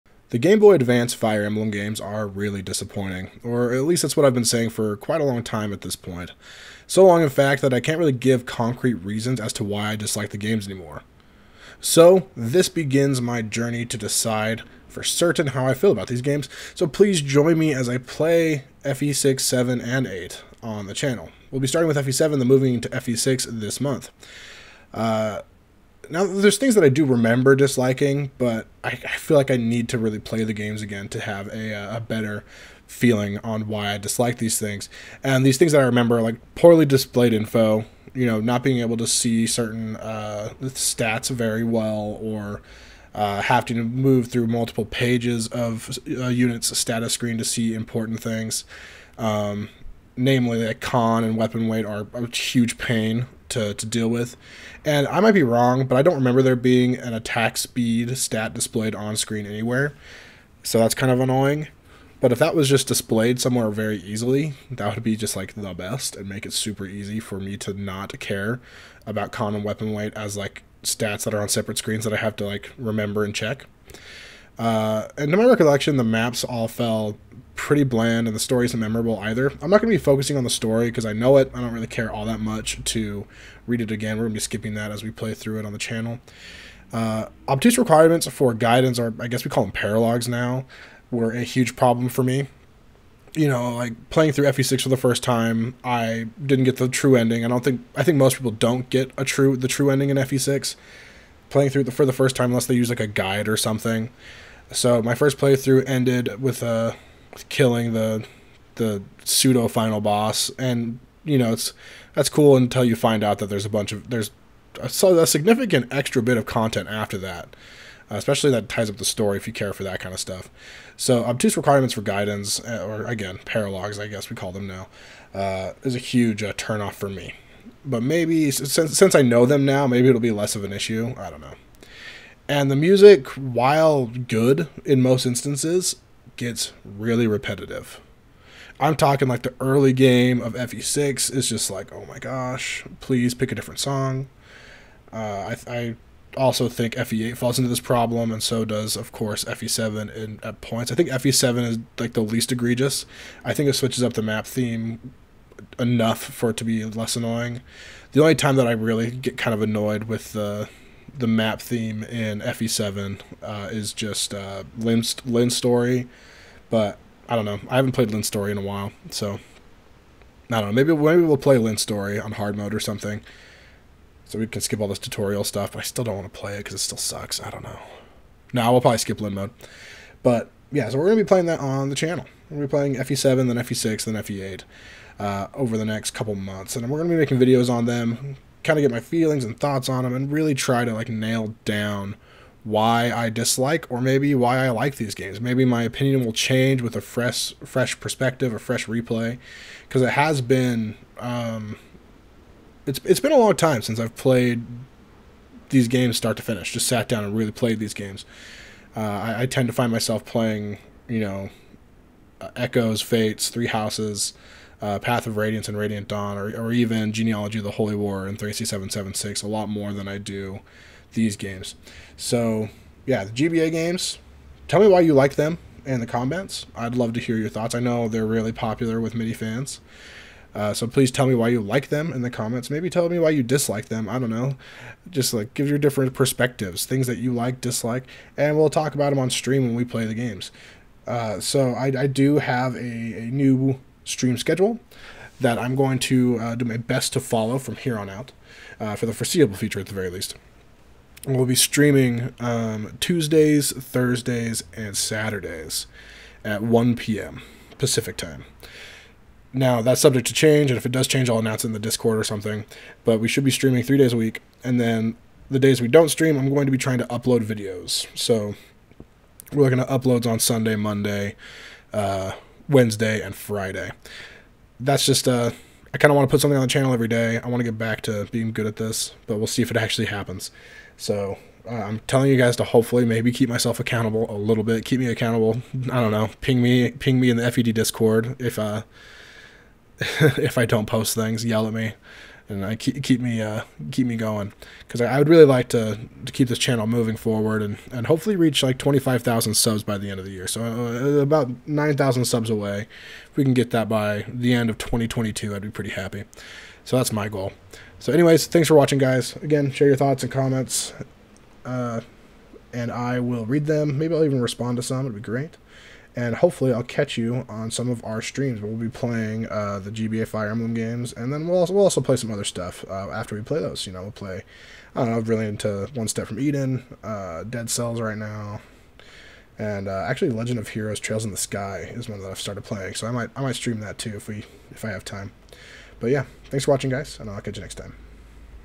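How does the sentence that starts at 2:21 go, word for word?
It's just like, oh my gosh, please pick a different song.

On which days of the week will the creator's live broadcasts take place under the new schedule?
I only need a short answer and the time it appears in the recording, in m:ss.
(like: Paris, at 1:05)
Tuesdays, Thursdays, and Saturdays, at 4:12.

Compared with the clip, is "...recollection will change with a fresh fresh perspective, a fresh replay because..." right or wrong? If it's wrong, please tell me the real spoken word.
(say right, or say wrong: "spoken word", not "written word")
wrong: "opinion", not "recollection".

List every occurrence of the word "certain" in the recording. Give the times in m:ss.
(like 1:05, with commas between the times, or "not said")
0:15, 0:39.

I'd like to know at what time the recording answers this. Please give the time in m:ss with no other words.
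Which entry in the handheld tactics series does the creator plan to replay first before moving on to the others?
0:21.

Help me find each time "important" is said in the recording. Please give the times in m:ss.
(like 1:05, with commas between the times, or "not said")
0:47.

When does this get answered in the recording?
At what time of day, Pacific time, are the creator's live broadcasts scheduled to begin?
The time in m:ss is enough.
4:16.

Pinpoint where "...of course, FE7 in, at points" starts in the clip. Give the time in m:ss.
2:28.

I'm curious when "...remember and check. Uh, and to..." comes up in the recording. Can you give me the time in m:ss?
1:12.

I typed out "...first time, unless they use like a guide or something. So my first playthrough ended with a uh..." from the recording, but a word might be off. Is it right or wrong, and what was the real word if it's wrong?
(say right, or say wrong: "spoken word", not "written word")
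right.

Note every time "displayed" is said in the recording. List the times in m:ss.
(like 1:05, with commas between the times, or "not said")
0:36, 0:58, 1:02.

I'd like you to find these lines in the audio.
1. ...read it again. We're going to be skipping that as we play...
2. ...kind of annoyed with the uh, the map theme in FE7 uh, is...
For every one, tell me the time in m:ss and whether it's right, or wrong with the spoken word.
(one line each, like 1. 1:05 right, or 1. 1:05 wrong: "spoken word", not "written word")
1. 1:23 right
2. 2:39 right.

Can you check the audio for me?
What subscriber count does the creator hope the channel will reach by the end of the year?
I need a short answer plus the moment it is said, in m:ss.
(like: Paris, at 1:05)
25,000, at 4:58.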